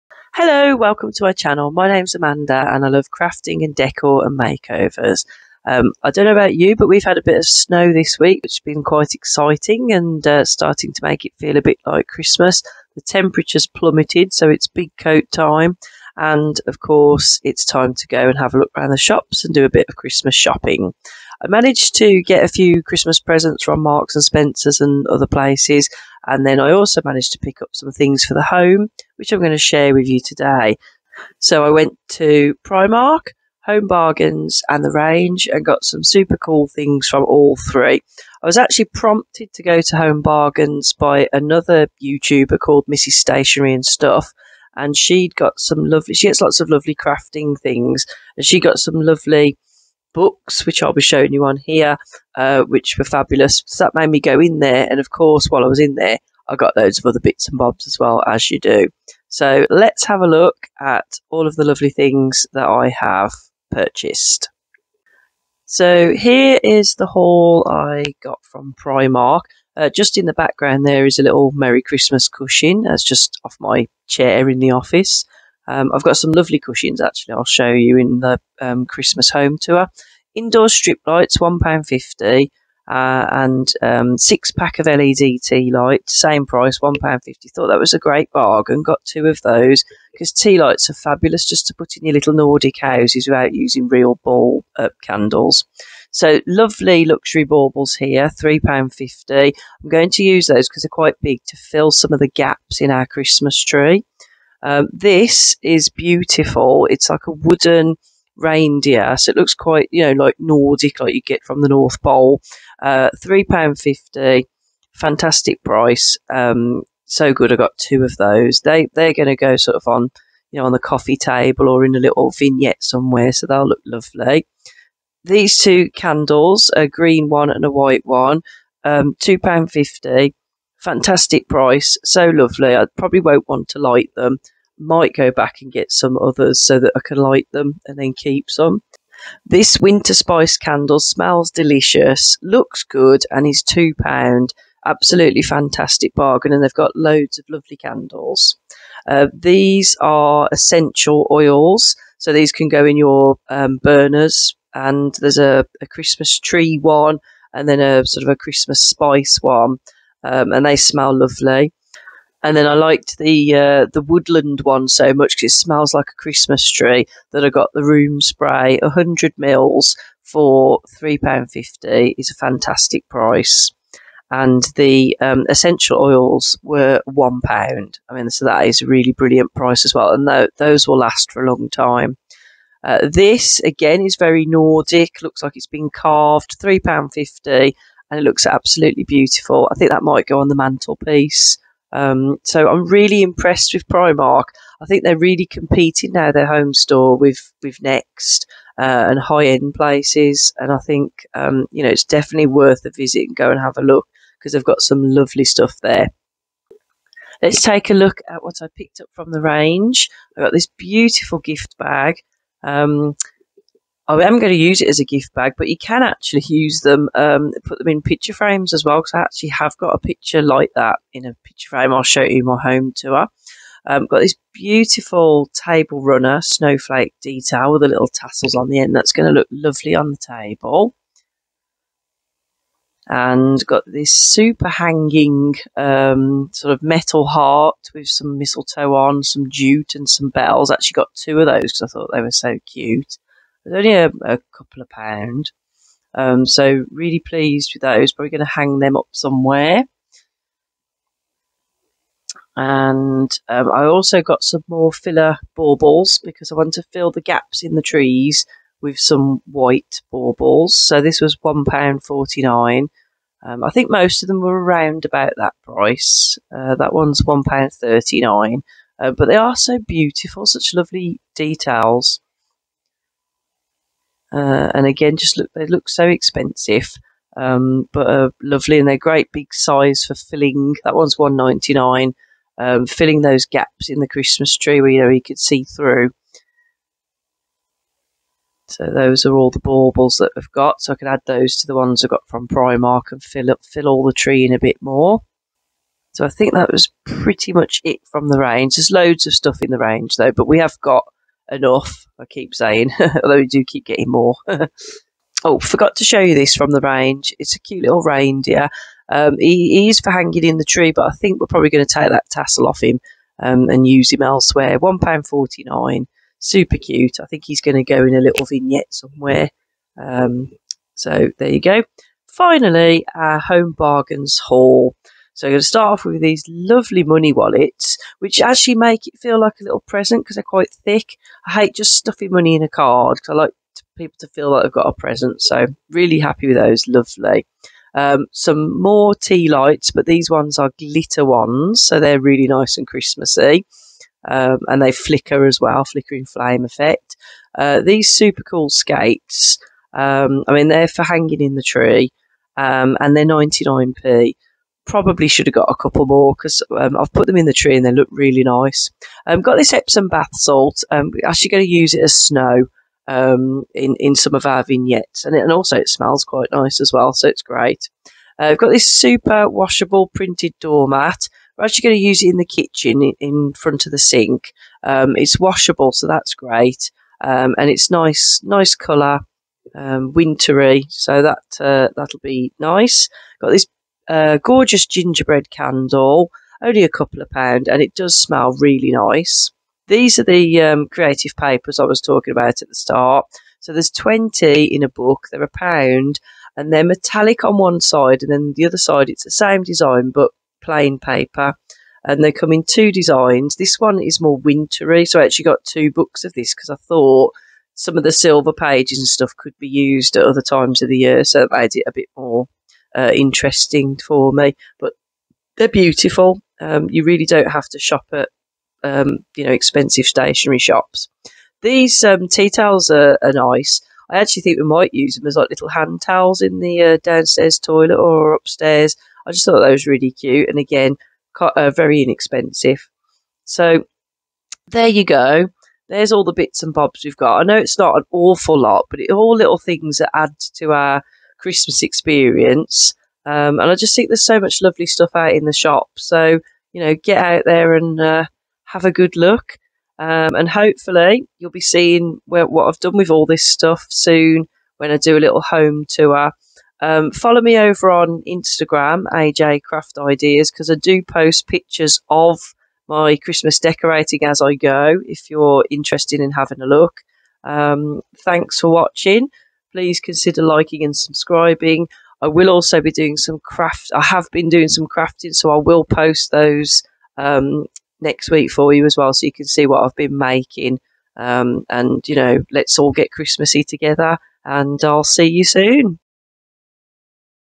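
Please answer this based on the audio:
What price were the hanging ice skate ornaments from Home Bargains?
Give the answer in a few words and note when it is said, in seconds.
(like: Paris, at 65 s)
99p, at 353 s.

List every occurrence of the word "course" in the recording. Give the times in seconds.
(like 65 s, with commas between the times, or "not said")
16 s, 55 s.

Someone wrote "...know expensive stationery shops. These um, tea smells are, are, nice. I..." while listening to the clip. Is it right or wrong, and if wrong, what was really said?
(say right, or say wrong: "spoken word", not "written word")
wrong: "towels", not "smells".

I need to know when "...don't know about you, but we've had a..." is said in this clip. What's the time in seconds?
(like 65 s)
6 s.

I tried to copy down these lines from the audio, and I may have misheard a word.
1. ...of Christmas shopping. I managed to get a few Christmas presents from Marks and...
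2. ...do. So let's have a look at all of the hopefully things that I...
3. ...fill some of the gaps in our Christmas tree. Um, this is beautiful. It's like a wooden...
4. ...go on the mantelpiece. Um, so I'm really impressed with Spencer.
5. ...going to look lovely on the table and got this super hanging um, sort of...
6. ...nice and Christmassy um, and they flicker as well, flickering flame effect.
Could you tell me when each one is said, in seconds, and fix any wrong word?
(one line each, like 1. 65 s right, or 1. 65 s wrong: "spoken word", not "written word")
1. 19 s right
2. 58 s wrong: "lovely", not "hopefully"
3. 101 s right
4. 190 s wrong: "Primark", not "Spencer"
5. 229 s right
6. 342 s right.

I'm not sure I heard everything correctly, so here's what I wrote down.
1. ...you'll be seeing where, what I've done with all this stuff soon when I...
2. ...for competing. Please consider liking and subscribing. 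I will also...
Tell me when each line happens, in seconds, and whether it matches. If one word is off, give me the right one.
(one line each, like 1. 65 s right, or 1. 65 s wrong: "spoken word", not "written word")
1. 451 s right
2. 468 s wrong: "watching", not "competing".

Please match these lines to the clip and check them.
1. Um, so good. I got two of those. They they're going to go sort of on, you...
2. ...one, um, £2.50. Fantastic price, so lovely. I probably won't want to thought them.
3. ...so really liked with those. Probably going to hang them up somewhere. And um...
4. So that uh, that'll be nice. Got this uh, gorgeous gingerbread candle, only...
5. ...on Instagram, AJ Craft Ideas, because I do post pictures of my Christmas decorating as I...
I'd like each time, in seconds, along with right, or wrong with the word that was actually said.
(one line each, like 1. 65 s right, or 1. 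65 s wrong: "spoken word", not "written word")
1. 116 s right
2. 128 s wrong: "light", not "thought"
3. 246 s wrong: "pleased", not "liked"
4. 380 s right
5. 457 s right.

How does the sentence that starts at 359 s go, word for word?
I've um, got this Epsom bath salt.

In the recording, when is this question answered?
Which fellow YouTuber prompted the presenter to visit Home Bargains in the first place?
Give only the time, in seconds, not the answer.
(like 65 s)
42 s.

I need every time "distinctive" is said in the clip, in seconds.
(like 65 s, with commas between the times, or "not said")
not said.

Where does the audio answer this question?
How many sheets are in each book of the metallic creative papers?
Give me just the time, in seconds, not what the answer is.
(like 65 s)
393 s.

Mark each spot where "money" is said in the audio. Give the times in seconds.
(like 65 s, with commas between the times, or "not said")
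327 s, 332 s.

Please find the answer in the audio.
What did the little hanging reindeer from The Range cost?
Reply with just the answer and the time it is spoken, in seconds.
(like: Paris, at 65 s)
£1.49, at 314 s.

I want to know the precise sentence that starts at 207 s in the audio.
Let's take a look at what I picked up from the range.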